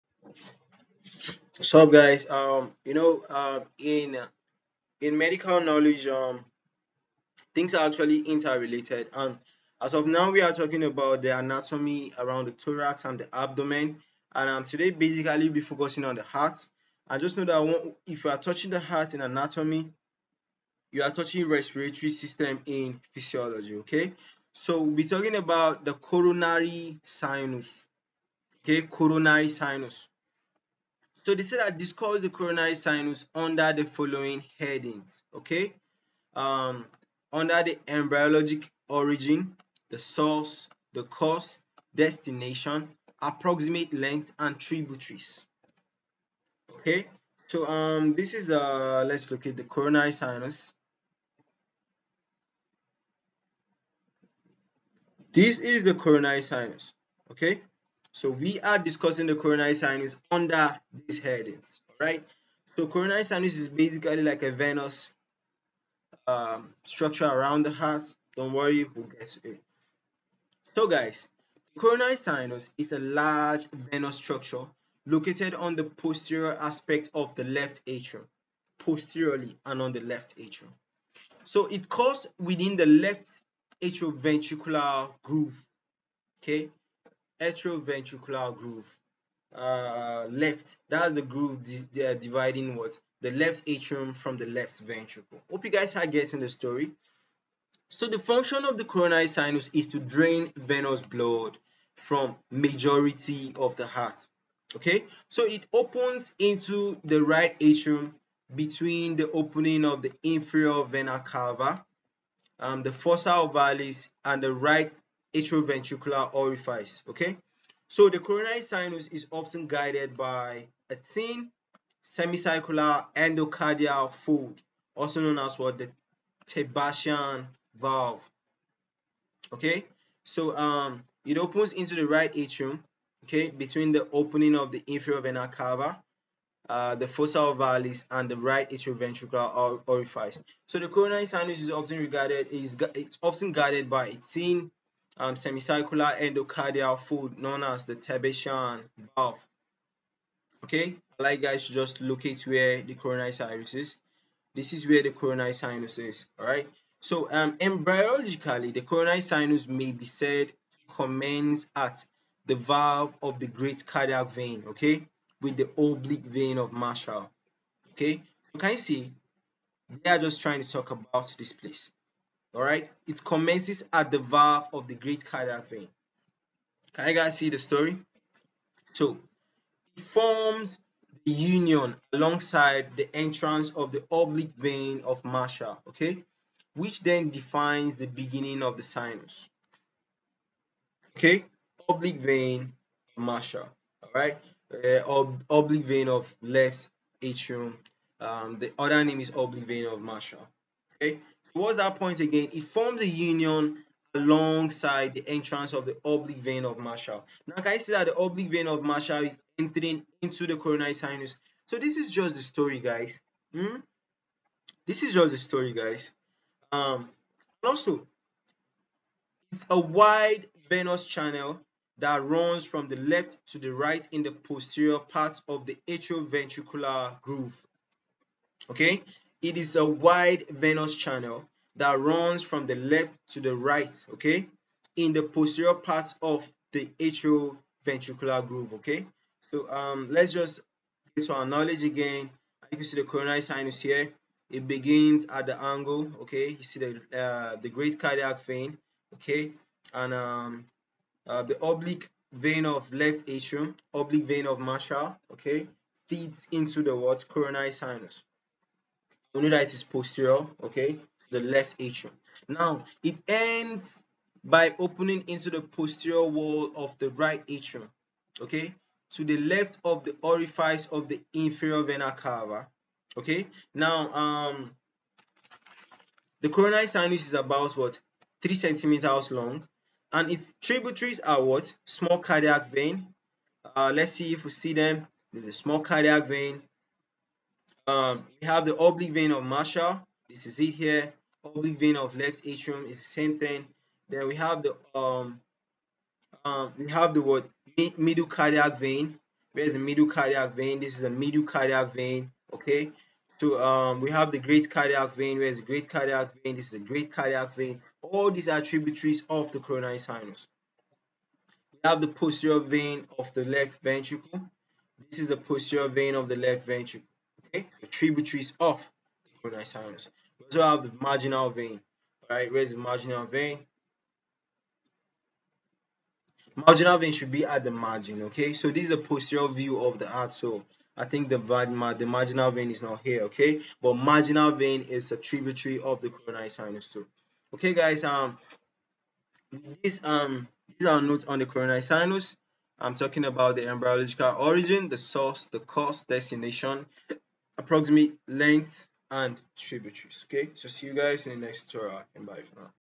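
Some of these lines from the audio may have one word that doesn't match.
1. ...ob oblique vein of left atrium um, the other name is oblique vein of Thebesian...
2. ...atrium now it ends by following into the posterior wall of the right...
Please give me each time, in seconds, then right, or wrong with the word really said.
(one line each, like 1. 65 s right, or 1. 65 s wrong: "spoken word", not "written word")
1. 195 s wrong: "Marshall", not "Thebesian"
2. 261 s wrong: "opening", not "following".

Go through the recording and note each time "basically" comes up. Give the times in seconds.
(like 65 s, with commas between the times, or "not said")
14 s, 63 s.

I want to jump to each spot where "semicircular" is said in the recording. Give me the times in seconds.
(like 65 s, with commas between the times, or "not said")
122 s, 145 s.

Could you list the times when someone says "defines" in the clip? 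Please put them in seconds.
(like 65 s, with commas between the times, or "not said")
187 s.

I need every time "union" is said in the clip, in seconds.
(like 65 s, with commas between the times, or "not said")
181 s, 203 s.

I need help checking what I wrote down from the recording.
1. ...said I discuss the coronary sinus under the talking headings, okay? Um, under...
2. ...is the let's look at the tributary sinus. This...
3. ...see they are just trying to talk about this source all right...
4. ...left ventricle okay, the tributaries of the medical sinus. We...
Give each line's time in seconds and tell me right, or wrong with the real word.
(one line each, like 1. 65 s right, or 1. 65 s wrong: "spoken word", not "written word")
1. 31 s wrong: "following", not "talking"
2. 48 s wrong: "coronary", not "tributary"
3. 168 s wrong: "place", not "source"
4. 316 s wrong: "coronal", not "medical".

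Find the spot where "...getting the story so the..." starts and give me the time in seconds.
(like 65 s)
96 s.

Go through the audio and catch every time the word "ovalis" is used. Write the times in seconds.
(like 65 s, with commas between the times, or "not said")
113 s, 137 s.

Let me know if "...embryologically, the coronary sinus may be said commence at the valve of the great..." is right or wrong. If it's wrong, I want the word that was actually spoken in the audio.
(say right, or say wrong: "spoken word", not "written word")
right.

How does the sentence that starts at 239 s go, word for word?
So um, let's just get to our knowledge again.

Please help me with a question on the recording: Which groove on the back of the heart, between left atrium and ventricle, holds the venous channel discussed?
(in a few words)
left atrioventricular groove.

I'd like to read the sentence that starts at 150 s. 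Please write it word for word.
Okay, I like guys to just locate where the coronary sinus is.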